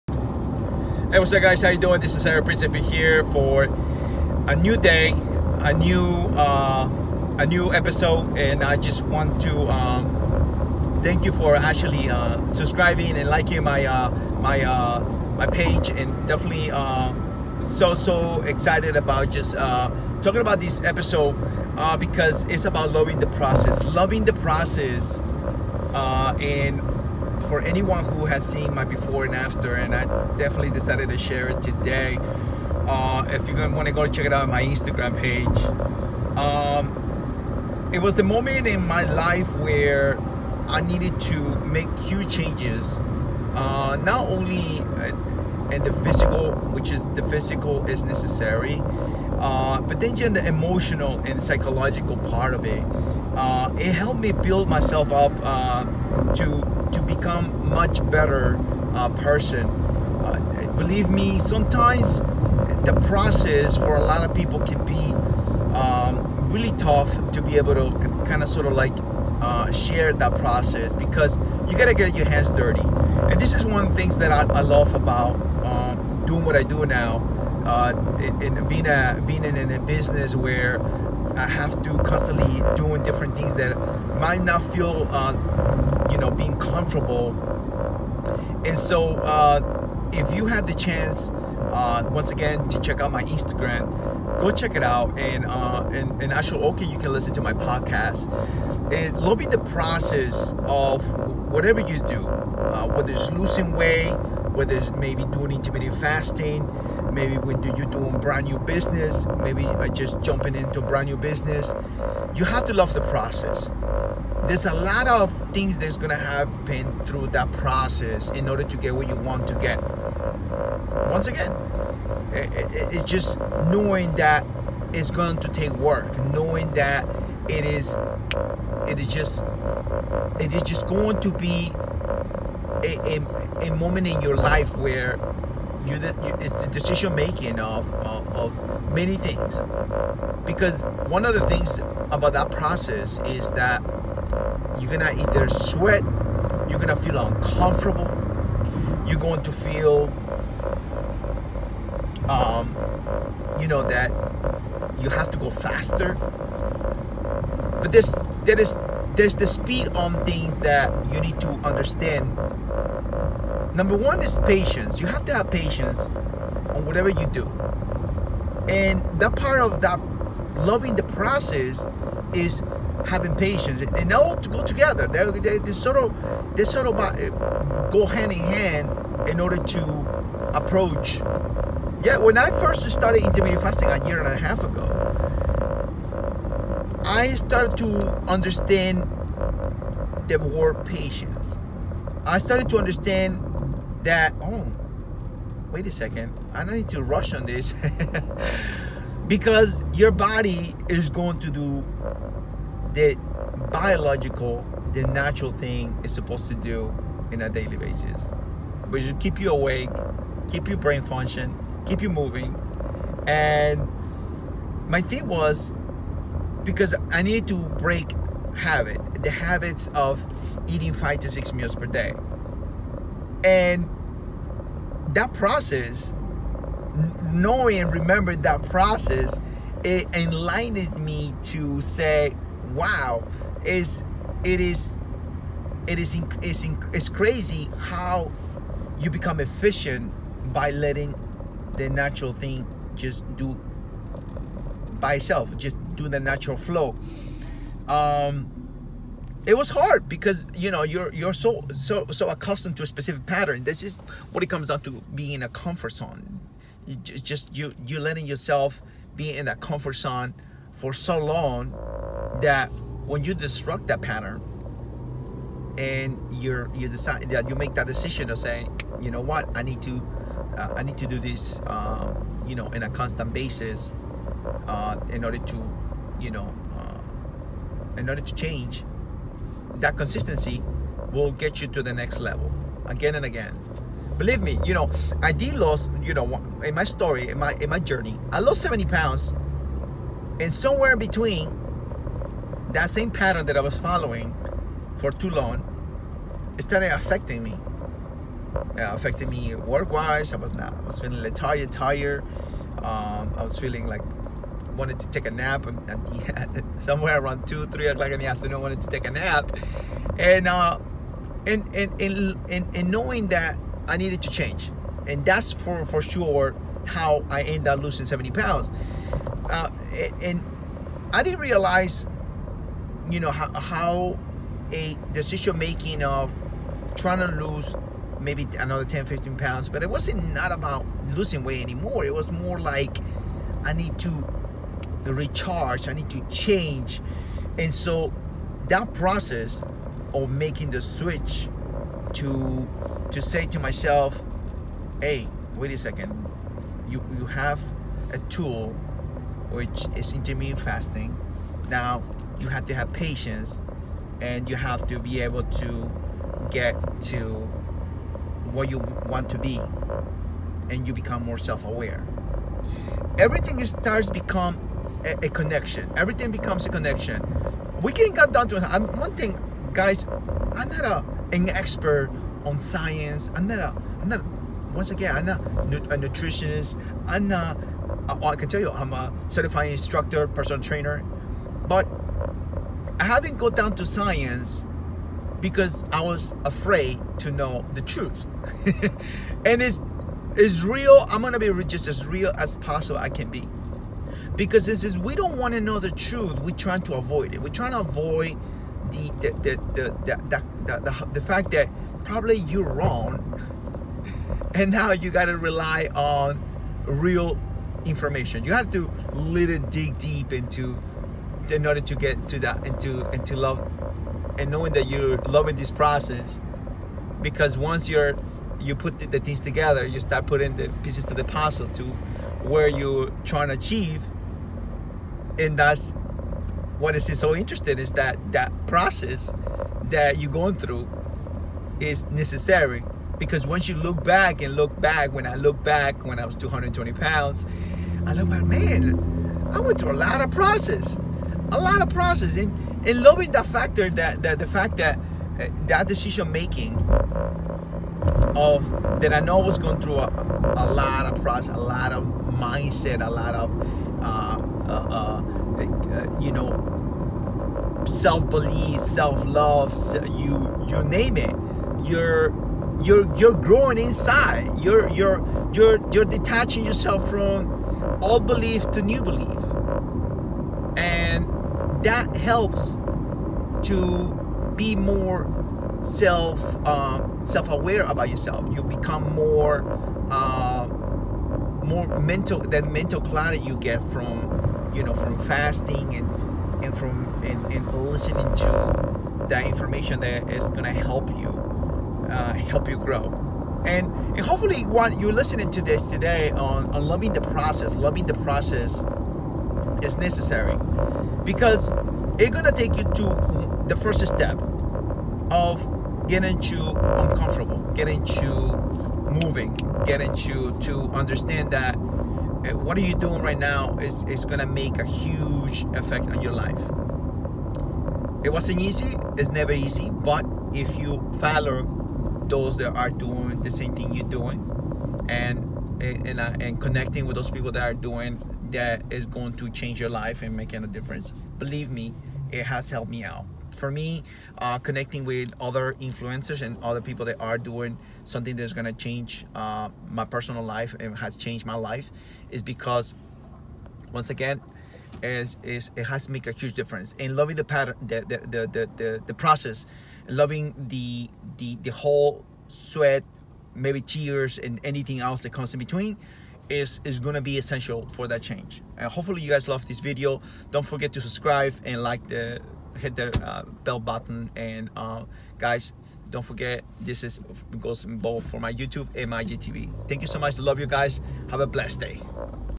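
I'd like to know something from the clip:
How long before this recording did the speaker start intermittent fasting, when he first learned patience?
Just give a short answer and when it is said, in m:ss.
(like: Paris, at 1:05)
A year and a half, at 3:03.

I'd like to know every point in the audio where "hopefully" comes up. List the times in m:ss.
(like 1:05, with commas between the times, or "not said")
8:14, 9:18.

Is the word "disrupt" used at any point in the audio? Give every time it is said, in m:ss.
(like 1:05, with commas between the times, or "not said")
4:23.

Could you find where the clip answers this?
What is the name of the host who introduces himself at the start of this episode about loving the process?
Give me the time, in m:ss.
0:02.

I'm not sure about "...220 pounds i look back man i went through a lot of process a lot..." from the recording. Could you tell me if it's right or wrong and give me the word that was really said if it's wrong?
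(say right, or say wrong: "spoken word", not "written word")
right.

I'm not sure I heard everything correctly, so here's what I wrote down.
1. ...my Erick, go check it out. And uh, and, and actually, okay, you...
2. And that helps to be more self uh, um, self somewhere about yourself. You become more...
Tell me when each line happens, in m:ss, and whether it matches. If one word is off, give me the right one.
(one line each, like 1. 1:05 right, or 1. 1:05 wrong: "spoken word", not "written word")
1. 1:33 wrong: "Instagram", not "Erick"
2. 7:50 wrong: "aware", not "somewhere".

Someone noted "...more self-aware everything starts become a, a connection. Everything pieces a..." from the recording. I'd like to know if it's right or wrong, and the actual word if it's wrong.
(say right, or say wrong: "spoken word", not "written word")
wrong: "becomes", not "pieces".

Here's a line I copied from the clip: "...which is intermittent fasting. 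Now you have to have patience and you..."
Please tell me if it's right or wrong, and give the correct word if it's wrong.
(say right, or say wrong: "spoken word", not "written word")
right.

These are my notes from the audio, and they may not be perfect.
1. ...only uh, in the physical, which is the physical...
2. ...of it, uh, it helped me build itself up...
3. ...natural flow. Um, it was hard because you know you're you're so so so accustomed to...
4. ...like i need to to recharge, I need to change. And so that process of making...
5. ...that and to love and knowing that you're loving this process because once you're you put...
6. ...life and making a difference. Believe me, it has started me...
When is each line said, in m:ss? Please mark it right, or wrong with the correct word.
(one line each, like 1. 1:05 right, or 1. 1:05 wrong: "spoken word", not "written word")
1. 0:44 right
2. 0:52 wrong: "myself", not "itself"
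3. 4:06 right
4. 5:32 right
5. 6:52 right
6. 8:49 wrong: "helped", not "started".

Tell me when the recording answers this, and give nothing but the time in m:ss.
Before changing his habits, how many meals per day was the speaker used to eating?
3:40.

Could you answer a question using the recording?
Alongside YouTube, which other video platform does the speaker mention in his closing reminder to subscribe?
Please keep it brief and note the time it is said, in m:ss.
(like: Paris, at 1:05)
IGTV, at 9:29.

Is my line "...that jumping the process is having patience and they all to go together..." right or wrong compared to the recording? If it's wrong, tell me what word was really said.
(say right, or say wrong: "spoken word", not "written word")
wrong: "loving", not "jumping".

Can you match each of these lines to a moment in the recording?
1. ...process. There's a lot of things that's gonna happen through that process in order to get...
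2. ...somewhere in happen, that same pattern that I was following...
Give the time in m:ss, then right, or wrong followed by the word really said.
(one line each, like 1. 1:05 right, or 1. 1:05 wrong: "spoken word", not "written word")
1. 1:53 right
2. 4:50 wrong: "between", not "happen".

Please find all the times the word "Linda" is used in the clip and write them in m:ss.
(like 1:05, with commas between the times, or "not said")
not said.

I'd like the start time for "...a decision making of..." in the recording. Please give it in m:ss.
5:24.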